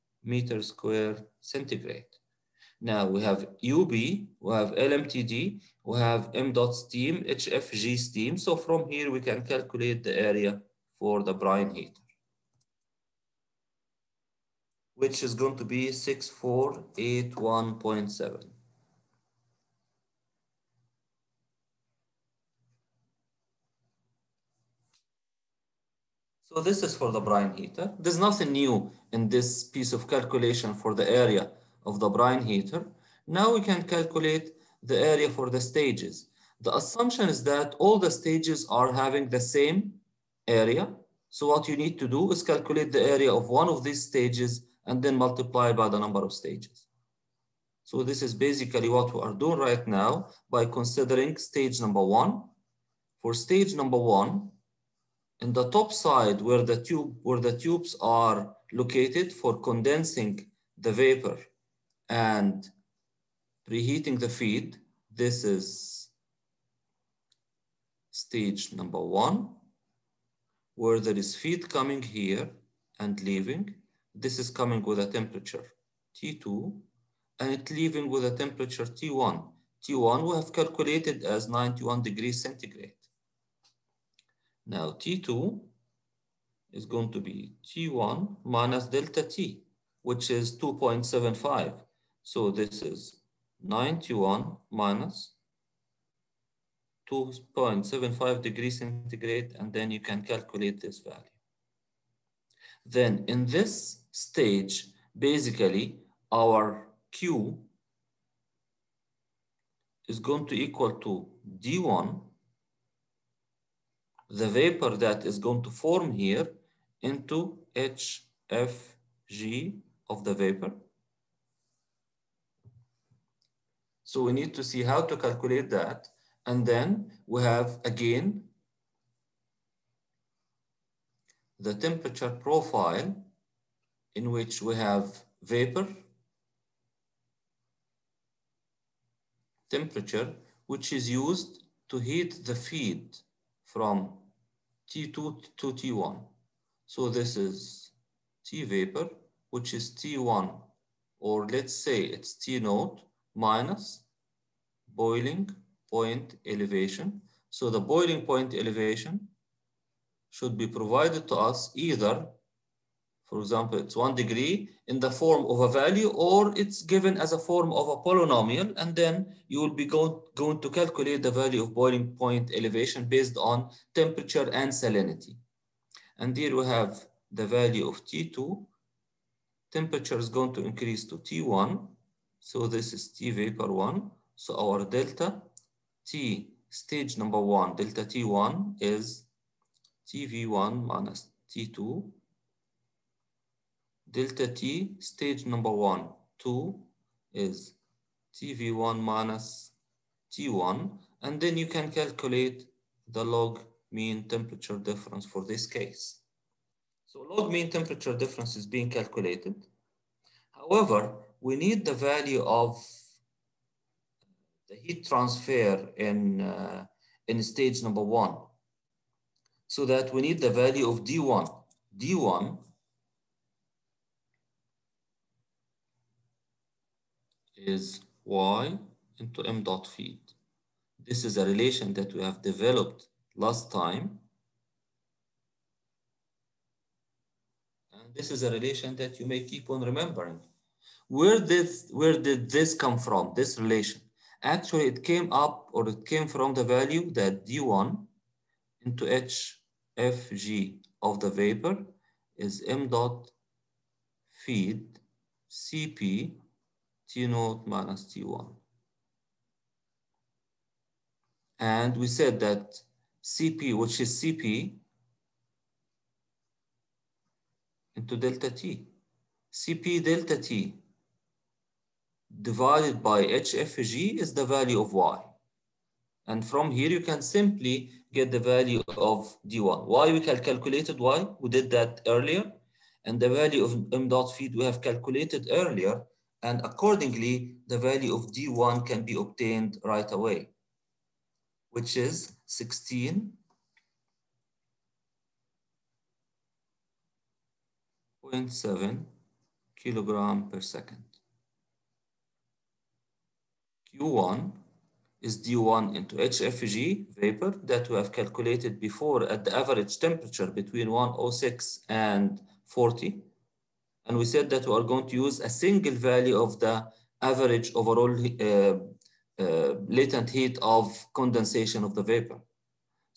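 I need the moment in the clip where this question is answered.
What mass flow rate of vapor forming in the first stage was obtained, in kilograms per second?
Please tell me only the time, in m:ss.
4:52.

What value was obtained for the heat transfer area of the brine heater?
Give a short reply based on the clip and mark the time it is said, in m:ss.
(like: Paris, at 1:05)
6481.7, at 0:15.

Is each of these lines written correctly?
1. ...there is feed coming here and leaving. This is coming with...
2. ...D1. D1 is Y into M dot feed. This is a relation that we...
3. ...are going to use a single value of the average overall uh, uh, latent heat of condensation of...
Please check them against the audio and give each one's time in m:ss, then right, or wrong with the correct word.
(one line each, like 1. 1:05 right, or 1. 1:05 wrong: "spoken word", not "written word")
1. 1:10 right
2. 3:41 right
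3. 5:14 right.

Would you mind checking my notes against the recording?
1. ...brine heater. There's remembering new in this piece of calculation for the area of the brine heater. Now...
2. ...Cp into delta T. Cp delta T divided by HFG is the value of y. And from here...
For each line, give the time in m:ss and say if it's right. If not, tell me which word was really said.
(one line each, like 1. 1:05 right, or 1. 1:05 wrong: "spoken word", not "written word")
1. 0:27 wrong: "nothing", not "remembering"
2. 4:24 right.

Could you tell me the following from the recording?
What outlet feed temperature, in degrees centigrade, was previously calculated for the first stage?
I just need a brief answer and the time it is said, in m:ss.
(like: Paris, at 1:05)
91, at 1:21.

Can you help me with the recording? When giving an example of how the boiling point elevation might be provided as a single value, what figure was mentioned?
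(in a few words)
1 degree.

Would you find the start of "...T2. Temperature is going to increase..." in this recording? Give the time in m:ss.
2:58.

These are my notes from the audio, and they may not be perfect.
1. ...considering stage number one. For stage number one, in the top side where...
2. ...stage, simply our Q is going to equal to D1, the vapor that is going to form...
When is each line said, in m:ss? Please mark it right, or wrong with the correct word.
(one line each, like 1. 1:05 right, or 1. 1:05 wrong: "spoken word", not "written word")
1. 0:50 right
2. 1:44 wrong: "basically", not "simply".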